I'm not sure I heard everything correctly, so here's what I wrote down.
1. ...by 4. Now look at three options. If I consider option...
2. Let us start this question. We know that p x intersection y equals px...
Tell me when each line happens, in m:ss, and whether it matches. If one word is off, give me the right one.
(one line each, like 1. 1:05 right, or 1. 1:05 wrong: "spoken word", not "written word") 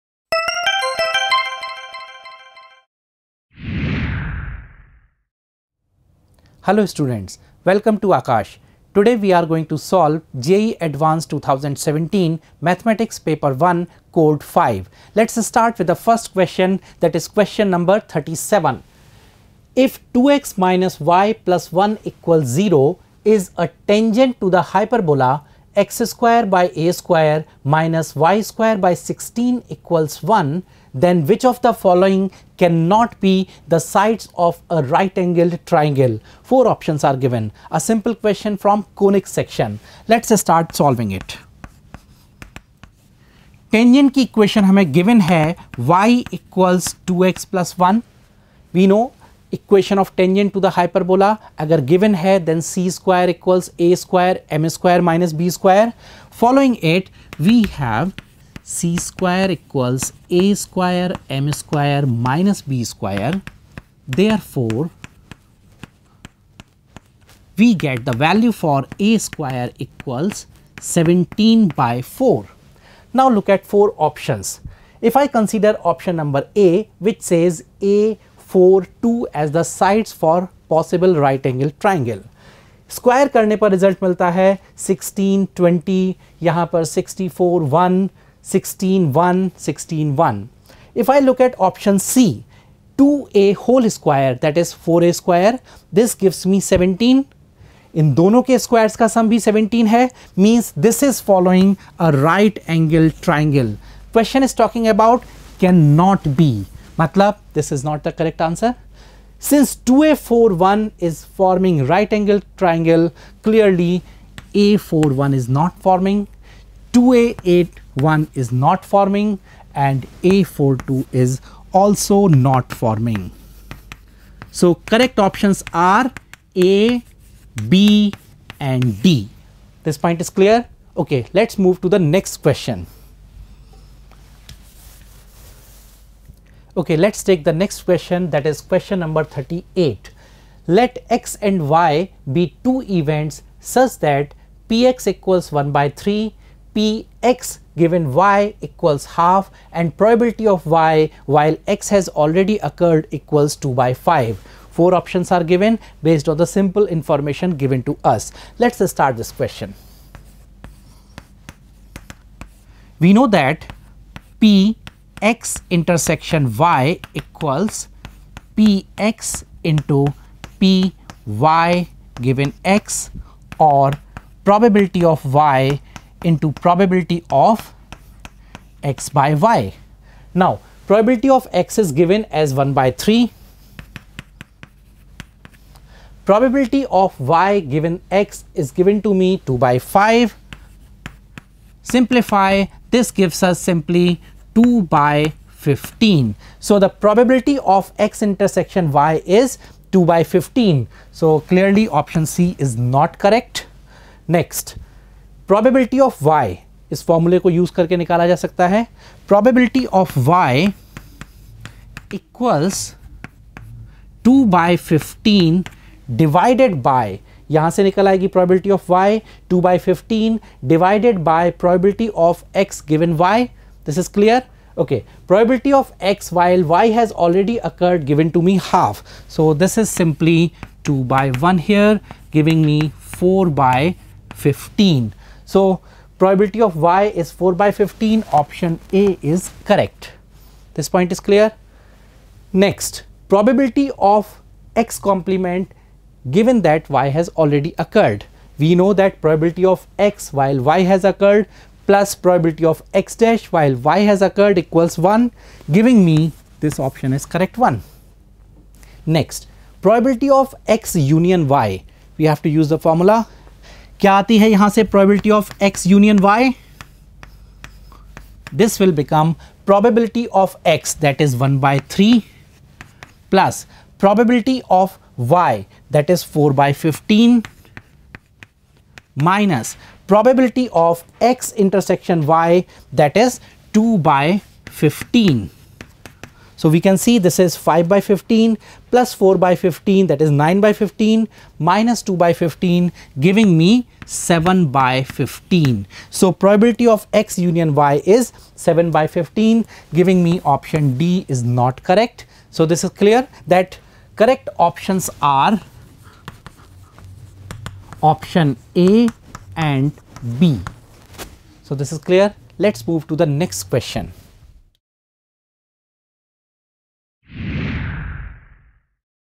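1. 1:11 wrong: "four", not "three"
2. 2:38 right.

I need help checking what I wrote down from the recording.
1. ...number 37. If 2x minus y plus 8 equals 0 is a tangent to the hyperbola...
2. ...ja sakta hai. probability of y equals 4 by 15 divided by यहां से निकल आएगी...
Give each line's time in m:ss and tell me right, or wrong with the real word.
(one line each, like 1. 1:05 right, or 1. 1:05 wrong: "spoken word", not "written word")
1. 0:17 wrong: "1", not "8"
2. 3:28 wrong: "2", not "4".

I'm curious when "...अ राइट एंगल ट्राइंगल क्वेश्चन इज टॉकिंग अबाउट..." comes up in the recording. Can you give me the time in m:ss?
1:42.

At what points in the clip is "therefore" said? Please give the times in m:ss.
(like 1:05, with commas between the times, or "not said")
1:04.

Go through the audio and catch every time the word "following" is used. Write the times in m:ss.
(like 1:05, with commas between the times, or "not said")
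0:31, 0:56.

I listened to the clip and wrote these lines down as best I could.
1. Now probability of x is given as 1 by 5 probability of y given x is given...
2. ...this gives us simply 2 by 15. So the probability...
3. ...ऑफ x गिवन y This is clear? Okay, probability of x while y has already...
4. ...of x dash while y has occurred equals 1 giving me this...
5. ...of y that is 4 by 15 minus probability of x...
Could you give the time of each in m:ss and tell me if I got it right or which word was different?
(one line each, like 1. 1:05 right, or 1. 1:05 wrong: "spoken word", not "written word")
1. 3:00 wrong: "3", not "5"
2. 3:12 right
3. 3:42 right
4. 4:12 right
5. 4:34 right.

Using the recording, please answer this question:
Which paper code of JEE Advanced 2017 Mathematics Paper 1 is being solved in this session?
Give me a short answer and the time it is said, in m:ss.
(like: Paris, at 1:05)
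Code 5, at 0:14.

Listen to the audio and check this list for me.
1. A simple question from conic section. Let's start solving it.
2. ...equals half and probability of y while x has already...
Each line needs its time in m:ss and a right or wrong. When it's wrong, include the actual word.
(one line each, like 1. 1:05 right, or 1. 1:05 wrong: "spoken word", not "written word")
1. 0:37 right
2. 2:28 right.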